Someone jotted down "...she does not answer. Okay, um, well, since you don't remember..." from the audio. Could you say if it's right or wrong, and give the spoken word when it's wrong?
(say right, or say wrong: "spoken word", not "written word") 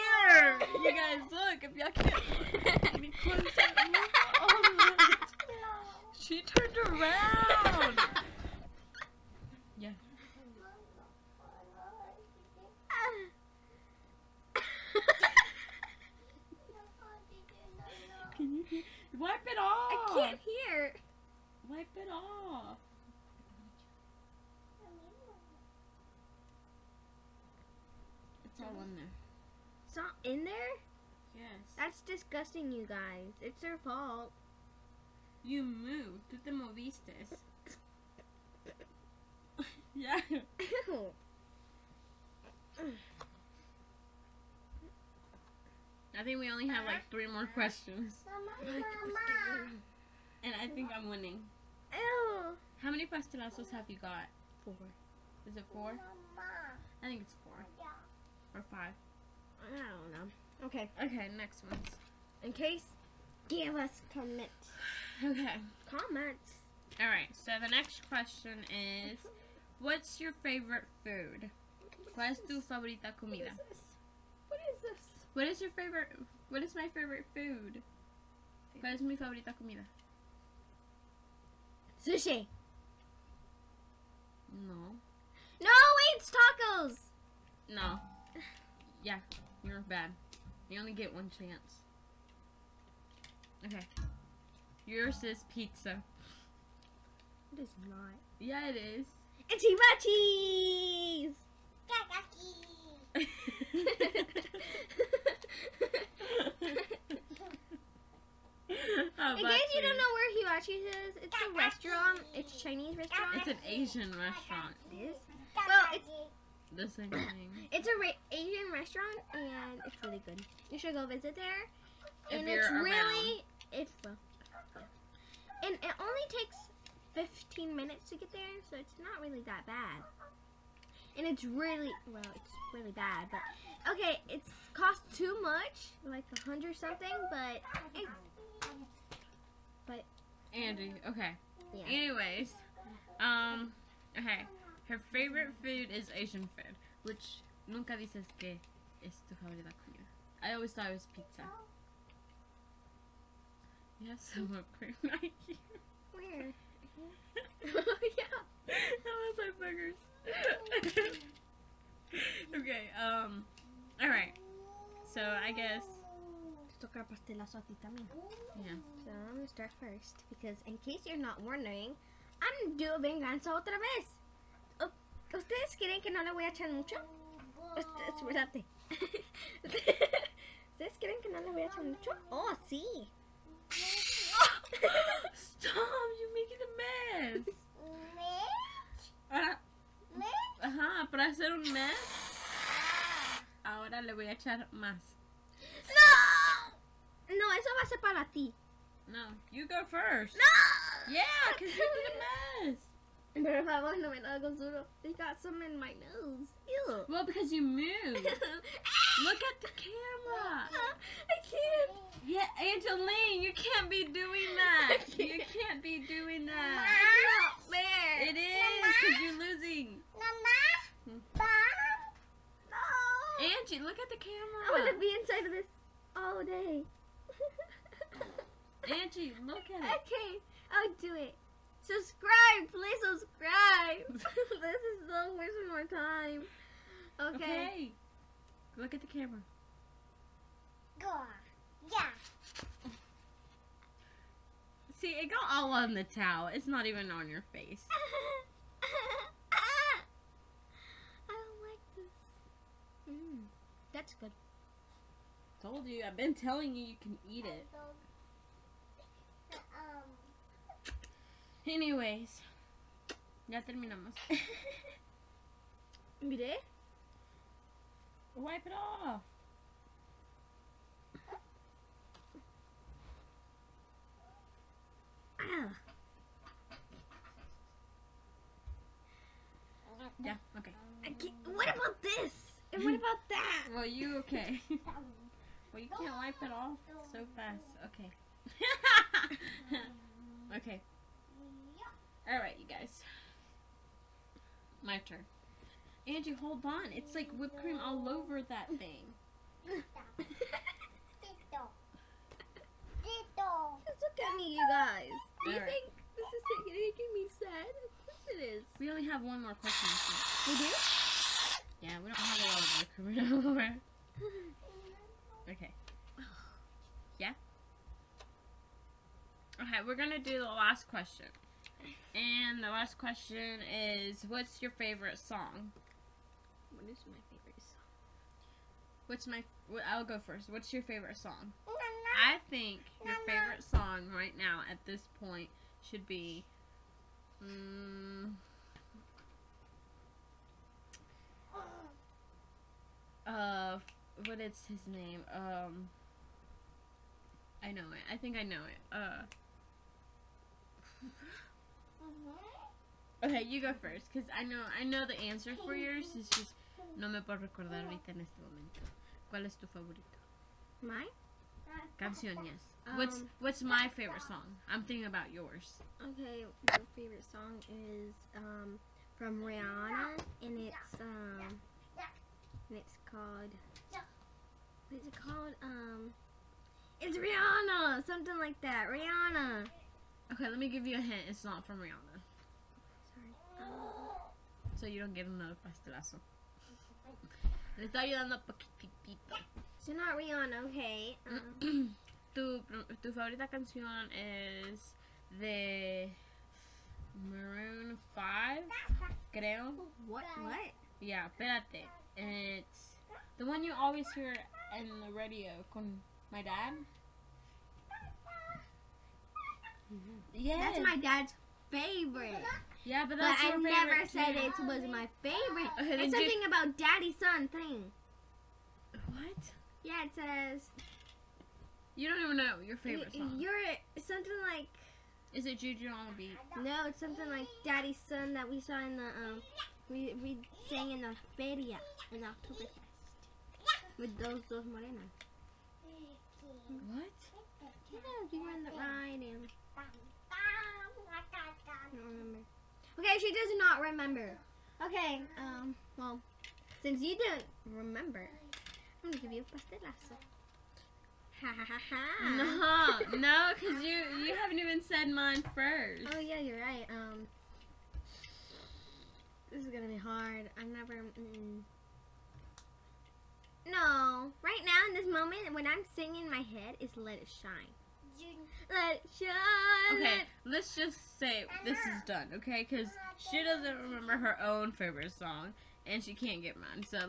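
wrong: "remember", not "answer".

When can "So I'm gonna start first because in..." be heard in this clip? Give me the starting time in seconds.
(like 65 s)
169 s.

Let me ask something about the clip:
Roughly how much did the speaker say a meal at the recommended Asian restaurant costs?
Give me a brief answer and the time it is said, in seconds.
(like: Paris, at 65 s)
A hundred something, at 136 s.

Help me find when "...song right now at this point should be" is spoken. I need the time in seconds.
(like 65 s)
333 s.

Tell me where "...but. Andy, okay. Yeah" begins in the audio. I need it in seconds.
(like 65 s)
139 s.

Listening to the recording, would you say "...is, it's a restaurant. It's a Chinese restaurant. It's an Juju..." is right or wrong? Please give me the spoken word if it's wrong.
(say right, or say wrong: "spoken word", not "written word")
wrong: "Asian", not "Juju".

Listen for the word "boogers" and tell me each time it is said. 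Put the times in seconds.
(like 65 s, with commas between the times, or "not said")
160 s.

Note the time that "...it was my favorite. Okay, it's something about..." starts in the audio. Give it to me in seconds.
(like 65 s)
414 s.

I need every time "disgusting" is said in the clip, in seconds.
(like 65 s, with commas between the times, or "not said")
32 s.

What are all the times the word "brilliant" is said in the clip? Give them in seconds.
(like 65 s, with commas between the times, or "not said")
not said.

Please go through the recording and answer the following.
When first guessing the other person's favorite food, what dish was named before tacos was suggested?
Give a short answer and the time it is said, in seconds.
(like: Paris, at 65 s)
Sushi, at 82 s.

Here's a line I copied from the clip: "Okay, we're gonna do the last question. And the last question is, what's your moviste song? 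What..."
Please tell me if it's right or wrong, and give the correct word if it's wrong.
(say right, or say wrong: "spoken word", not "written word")
wrong: "favorite", not "moviste".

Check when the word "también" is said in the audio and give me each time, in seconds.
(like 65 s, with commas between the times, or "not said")
167 s.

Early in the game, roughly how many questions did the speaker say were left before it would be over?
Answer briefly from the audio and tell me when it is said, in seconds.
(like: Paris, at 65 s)
3, at 47 s.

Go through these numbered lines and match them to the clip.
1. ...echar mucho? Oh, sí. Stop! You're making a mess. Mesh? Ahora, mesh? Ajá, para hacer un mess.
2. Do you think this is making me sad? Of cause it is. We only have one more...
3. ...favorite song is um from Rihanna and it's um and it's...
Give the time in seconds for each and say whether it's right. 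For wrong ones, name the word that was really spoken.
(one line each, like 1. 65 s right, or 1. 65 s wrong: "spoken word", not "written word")
1. 181 s right
2. 305 s wrong: "course", not "cause"
3. 366 s right.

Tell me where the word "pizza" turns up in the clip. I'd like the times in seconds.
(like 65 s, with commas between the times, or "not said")
95 s, 151 s.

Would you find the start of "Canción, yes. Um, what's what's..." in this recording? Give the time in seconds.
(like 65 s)
361 s.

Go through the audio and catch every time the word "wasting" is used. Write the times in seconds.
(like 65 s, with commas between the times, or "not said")
235 s.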